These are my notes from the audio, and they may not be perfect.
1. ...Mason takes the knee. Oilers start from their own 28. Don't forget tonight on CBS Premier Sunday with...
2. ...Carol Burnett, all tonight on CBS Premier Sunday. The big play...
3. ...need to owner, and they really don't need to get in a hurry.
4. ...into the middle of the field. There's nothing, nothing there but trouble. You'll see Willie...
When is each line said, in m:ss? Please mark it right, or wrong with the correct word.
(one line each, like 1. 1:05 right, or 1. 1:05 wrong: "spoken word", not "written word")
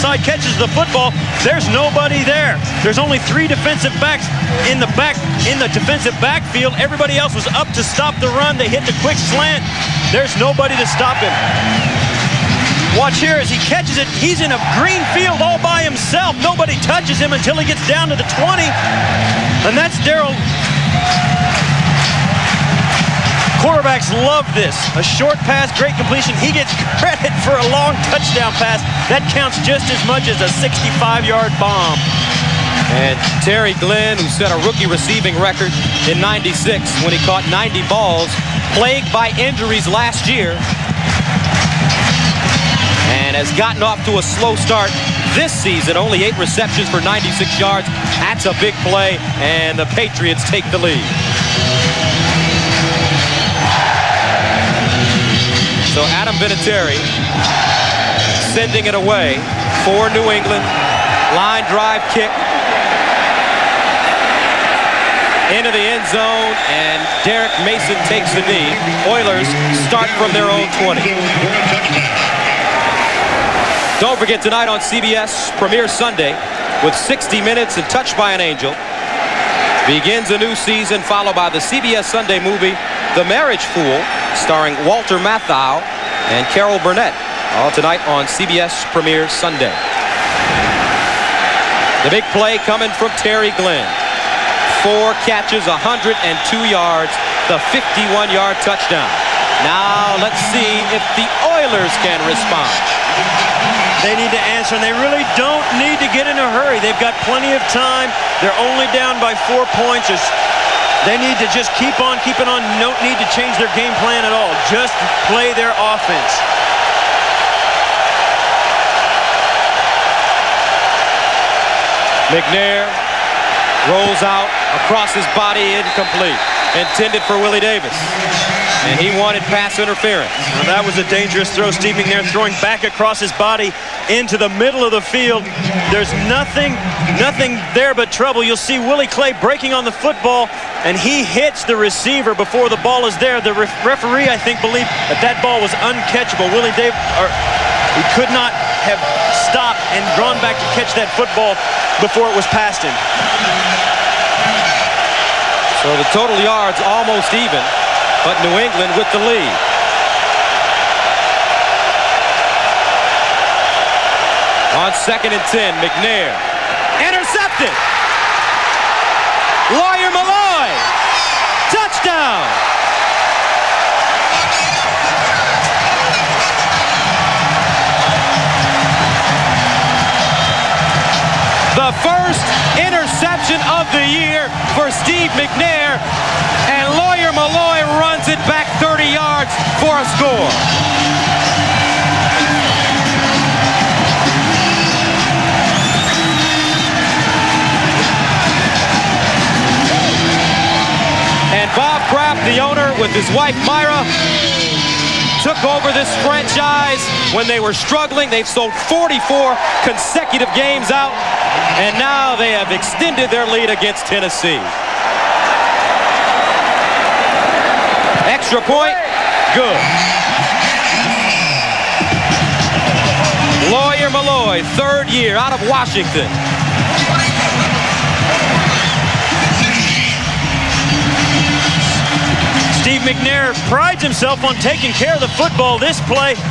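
1. 1:07 wrong: "20", not "28"
2. 1:26 right
3. 1:44 wrong: "answer", not "owner"
4. 2:14 right.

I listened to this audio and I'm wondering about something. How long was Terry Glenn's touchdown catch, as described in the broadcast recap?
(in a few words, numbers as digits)
51.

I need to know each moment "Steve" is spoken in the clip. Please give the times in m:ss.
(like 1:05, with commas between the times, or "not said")
2:11, 3:04, 3:53.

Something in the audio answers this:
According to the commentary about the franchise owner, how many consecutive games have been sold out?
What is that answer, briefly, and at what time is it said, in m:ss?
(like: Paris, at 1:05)
44, at 3:28.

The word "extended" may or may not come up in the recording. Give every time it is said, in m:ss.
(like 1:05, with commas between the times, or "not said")
3:32.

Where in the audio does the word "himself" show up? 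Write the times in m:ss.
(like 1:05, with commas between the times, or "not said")
0:15, 3:54.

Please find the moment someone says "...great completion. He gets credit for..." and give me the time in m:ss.
0:25.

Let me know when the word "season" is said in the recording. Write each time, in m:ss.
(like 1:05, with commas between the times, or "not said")
0:45, 1:20.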